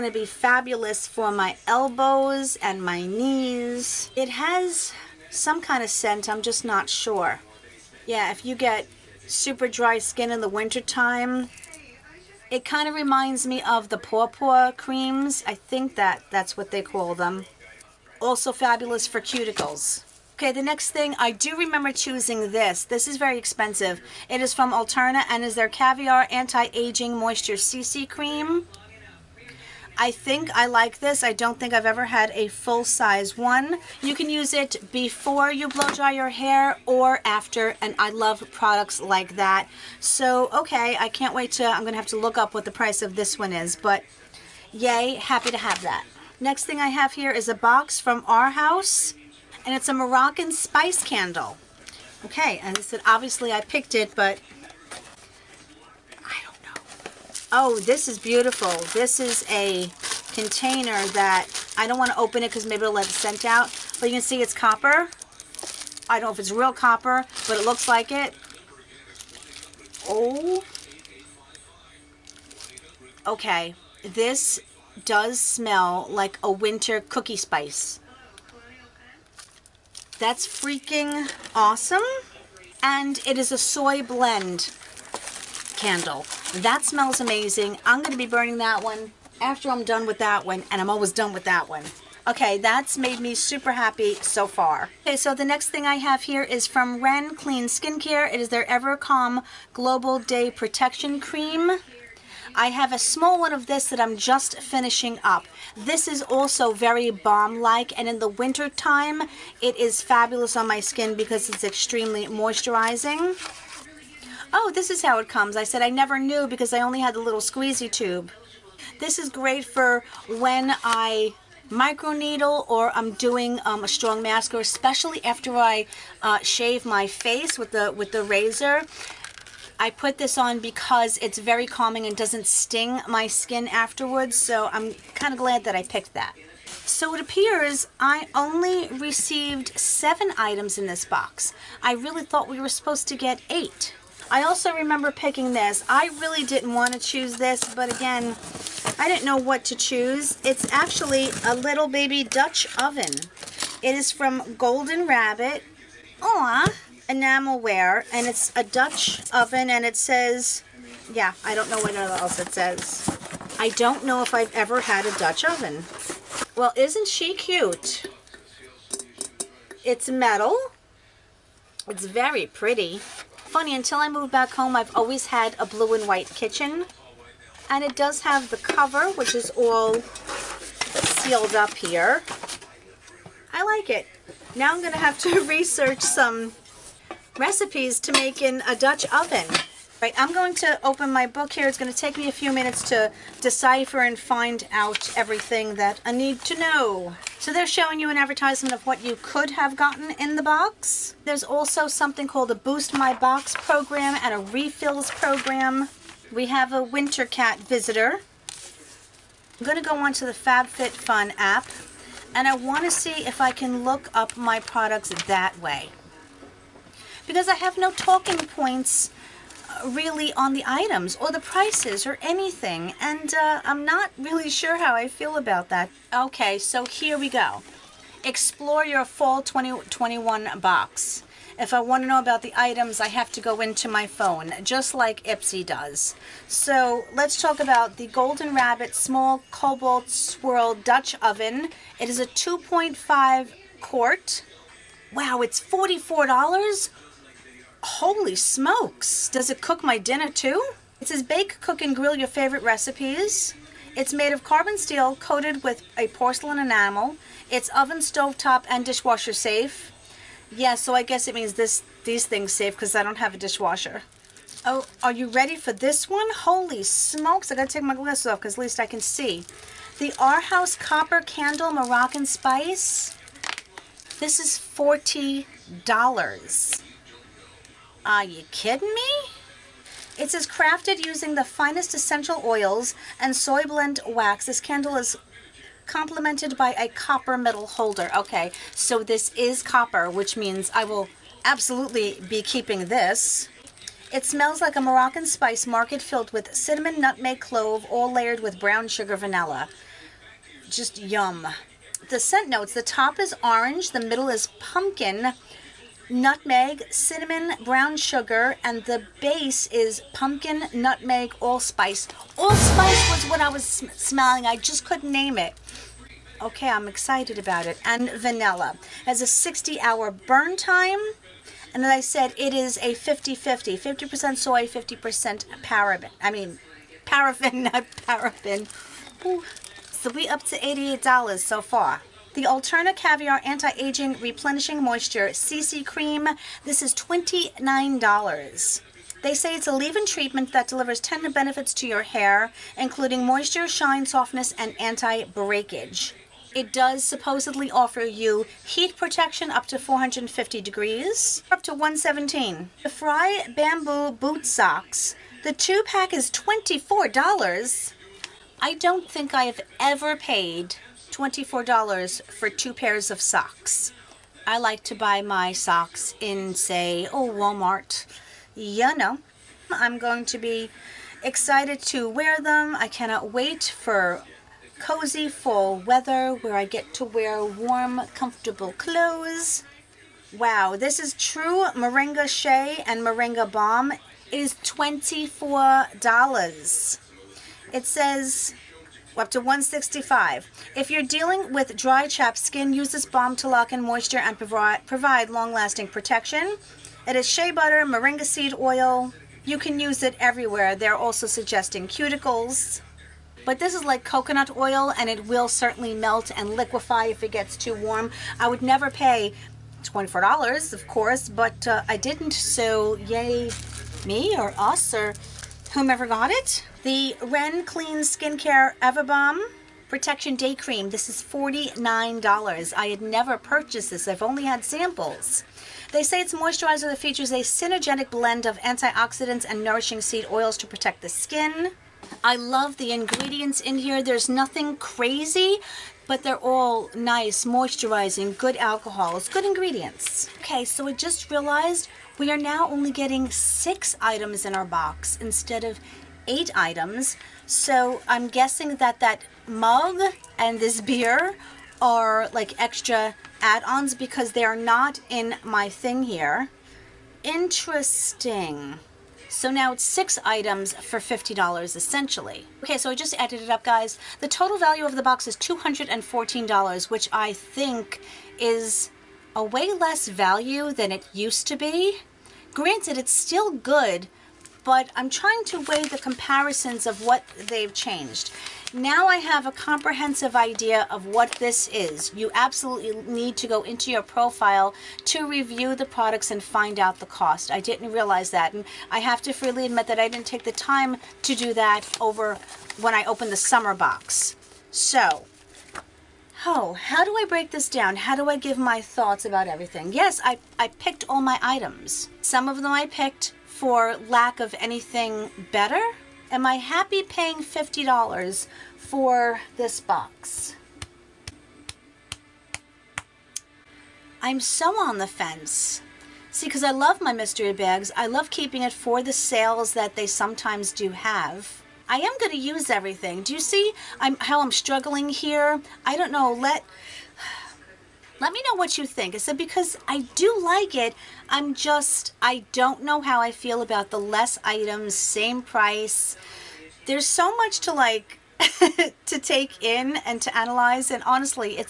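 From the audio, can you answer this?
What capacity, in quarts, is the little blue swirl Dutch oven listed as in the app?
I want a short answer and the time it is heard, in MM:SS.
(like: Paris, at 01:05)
2.5 quarts, at 04:02.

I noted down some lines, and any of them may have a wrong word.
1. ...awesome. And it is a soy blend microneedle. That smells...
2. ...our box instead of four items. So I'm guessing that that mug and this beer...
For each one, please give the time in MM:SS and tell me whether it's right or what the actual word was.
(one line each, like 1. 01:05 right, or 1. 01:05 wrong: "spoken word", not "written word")
1. 01:21 wrong: "candle", not "microneedle"
2. 07:24 wrong: "eight", not "four".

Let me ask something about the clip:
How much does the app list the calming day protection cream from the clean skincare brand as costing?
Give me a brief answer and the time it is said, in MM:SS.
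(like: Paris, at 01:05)
$49, at 07:01.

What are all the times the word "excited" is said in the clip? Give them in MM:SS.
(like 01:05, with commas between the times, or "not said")
05:16, 06:11.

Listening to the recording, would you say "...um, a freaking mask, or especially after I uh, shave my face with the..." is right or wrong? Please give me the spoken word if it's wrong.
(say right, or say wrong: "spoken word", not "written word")
wrong: "strong", not "freaking".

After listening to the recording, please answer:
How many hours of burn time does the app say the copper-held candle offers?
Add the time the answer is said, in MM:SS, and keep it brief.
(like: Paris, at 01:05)
60 hours, at 05:19.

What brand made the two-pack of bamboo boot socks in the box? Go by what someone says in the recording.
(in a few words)
Frye.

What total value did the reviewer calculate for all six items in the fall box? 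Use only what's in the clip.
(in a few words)
$214.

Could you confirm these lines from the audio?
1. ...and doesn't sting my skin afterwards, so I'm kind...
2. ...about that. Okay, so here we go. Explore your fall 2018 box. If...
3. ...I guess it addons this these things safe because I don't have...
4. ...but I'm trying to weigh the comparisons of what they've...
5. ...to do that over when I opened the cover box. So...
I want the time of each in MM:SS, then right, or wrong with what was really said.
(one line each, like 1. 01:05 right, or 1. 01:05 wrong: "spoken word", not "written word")
1. 02:12 right
2. 03:45 wrong: "2021", not "2018"
3. 04:20 wrong: "means", not "addons"
4. 07:54 right
5. 08:11 wrong: "summer", not "cover".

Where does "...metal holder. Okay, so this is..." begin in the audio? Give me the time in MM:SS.
04:47.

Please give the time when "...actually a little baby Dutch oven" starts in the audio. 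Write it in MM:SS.
02:30.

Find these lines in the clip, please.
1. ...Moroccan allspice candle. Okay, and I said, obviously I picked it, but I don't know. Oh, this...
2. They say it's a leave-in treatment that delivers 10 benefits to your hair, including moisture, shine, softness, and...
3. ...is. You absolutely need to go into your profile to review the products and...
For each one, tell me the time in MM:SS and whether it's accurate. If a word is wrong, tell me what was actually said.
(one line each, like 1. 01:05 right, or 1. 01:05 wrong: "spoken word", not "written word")
1. 00:49 wrong: "spice", not "allspice"
2. 05:39 right
3. 08:01 right.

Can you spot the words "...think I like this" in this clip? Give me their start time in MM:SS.
00:30.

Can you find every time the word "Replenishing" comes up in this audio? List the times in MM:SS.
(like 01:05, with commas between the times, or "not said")
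05:34.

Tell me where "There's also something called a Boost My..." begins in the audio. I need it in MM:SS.
03:21.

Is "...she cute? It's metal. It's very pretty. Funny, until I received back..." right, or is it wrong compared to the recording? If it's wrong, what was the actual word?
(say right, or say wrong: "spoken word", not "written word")
wrong: "moved", not "received".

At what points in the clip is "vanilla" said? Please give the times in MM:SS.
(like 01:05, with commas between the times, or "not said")
04:59, 05:18.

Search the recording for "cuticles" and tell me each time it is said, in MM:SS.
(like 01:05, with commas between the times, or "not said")
00:19, 06:41.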